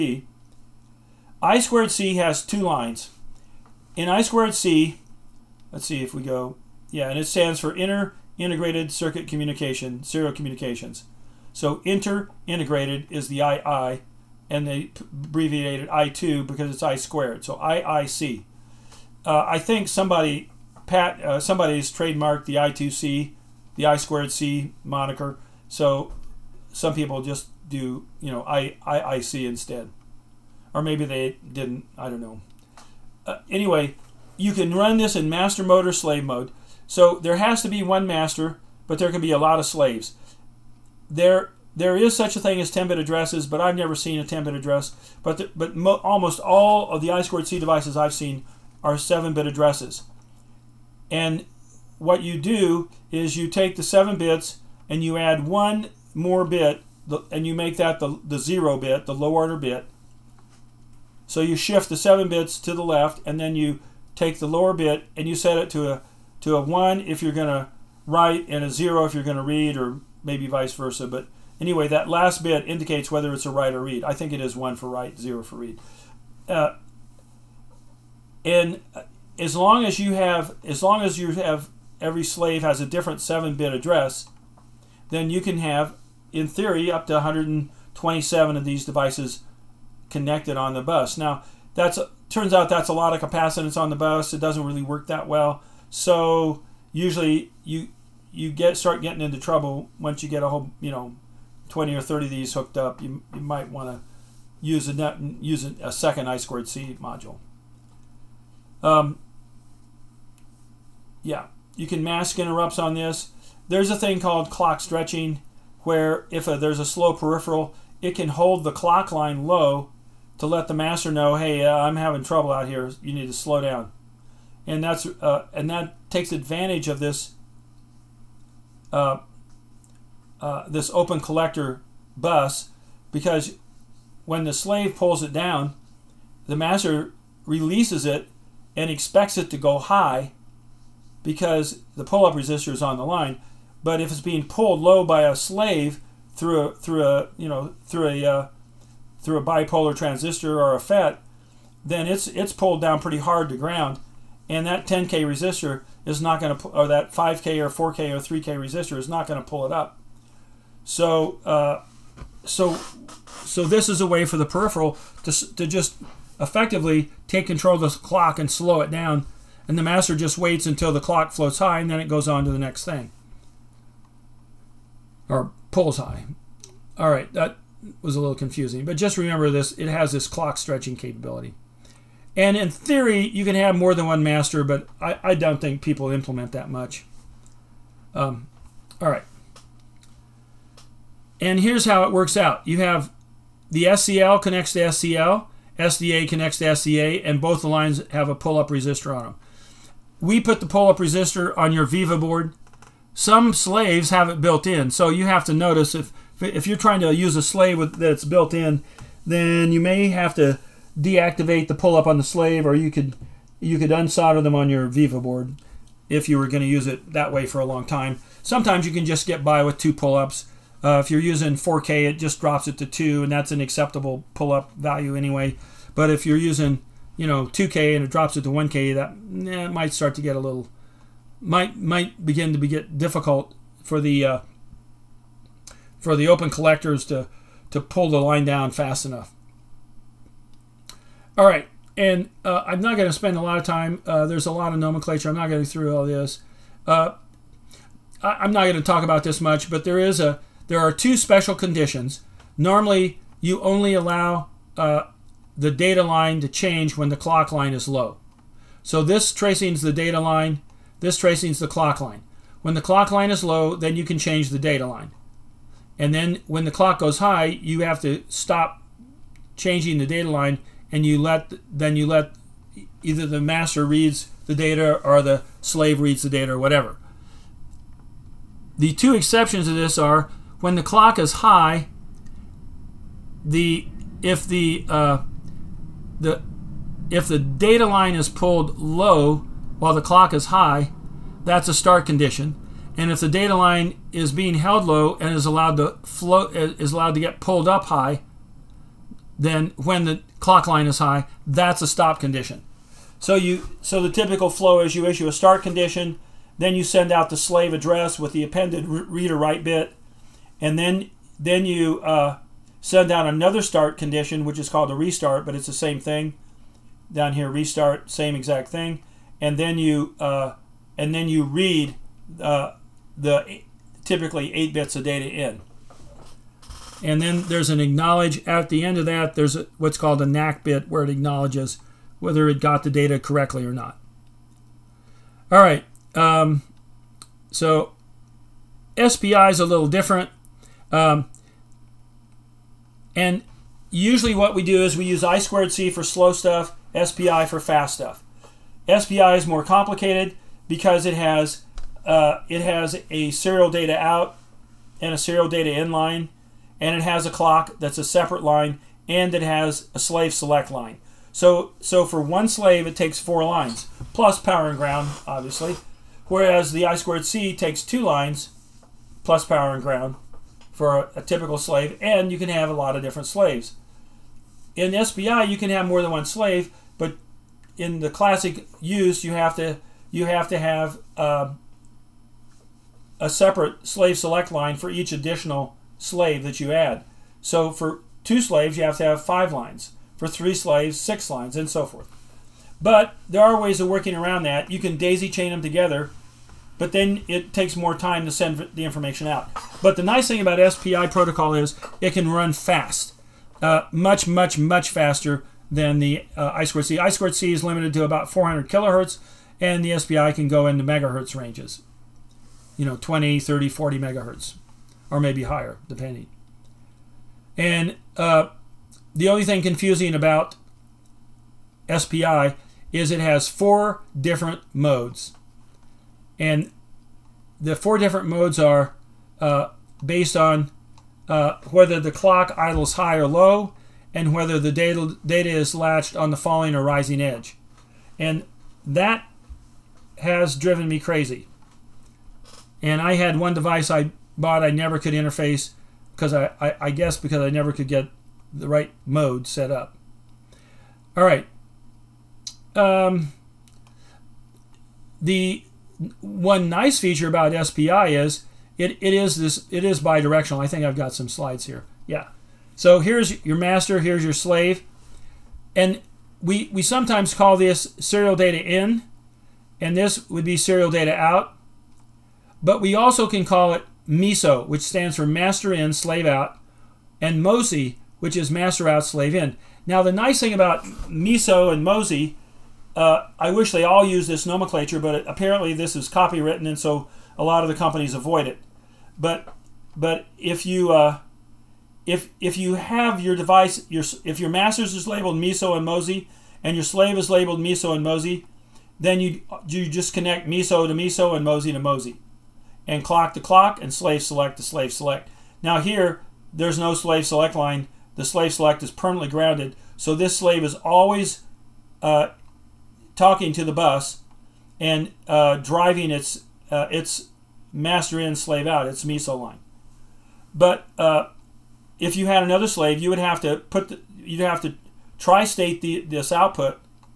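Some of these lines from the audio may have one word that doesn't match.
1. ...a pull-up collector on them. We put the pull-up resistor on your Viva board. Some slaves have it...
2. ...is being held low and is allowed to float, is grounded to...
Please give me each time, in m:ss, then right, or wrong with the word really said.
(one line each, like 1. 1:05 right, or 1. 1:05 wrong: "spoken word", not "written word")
1. 3:18 wrong: "resistor", not "collector"
2. 4:54 wrong: "allowed", not "grounded".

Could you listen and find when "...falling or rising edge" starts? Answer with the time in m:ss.
7:16.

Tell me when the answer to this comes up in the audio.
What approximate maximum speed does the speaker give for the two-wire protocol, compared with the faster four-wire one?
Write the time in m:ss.
6:48.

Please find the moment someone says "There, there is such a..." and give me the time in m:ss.
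0:41.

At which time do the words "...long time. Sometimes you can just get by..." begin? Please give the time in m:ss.
3:37.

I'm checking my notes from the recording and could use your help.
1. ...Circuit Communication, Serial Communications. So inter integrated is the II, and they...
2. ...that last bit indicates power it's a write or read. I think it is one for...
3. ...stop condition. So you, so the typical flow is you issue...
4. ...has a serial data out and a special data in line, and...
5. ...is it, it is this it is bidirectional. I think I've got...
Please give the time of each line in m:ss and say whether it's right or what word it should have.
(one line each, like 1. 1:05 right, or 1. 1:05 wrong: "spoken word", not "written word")
1. 0:08 right
2. 1:11 wrong: "whether", not "power"
3. 5:01 right
4. 5:52 wrong: "serial", not "special"
5. 7:38 right.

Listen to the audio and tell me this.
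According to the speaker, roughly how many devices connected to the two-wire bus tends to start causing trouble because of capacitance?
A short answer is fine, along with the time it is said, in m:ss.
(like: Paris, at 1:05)
20 or 30, at 1:41.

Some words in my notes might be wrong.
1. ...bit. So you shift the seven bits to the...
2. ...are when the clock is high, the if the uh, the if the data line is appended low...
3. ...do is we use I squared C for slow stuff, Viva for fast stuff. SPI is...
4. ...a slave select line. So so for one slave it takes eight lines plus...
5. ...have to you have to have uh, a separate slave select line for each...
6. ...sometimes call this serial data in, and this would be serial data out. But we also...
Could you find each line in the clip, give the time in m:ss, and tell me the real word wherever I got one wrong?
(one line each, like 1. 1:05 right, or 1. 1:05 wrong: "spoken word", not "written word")
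1. 0:59 right
2. 4:39 wrong: "pulled", not "appended"
3. 5:44 wrong: "SPI", not "Viva"
4. 5:59 wrong: "four", not "eight"
5. 6:19 right
6. 7:46 right.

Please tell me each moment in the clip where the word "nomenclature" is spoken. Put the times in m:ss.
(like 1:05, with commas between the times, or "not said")
4:04, 8:04.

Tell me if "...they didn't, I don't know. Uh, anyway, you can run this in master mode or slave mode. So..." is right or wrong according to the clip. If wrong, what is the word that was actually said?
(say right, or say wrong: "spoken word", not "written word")
right.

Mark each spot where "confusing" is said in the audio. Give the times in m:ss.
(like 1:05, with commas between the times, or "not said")
2:58, 6:59.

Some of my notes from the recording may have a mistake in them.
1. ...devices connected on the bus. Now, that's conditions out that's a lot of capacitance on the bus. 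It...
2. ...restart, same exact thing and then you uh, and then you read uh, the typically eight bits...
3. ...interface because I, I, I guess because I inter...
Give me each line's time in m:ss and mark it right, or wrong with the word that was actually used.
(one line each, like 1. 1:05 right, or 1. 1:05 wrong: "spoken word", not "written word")
1. 1:28 wrong: "turns", not "conditions"
2. 5:17 right
3. 7:25 wrong: "never", not "inter".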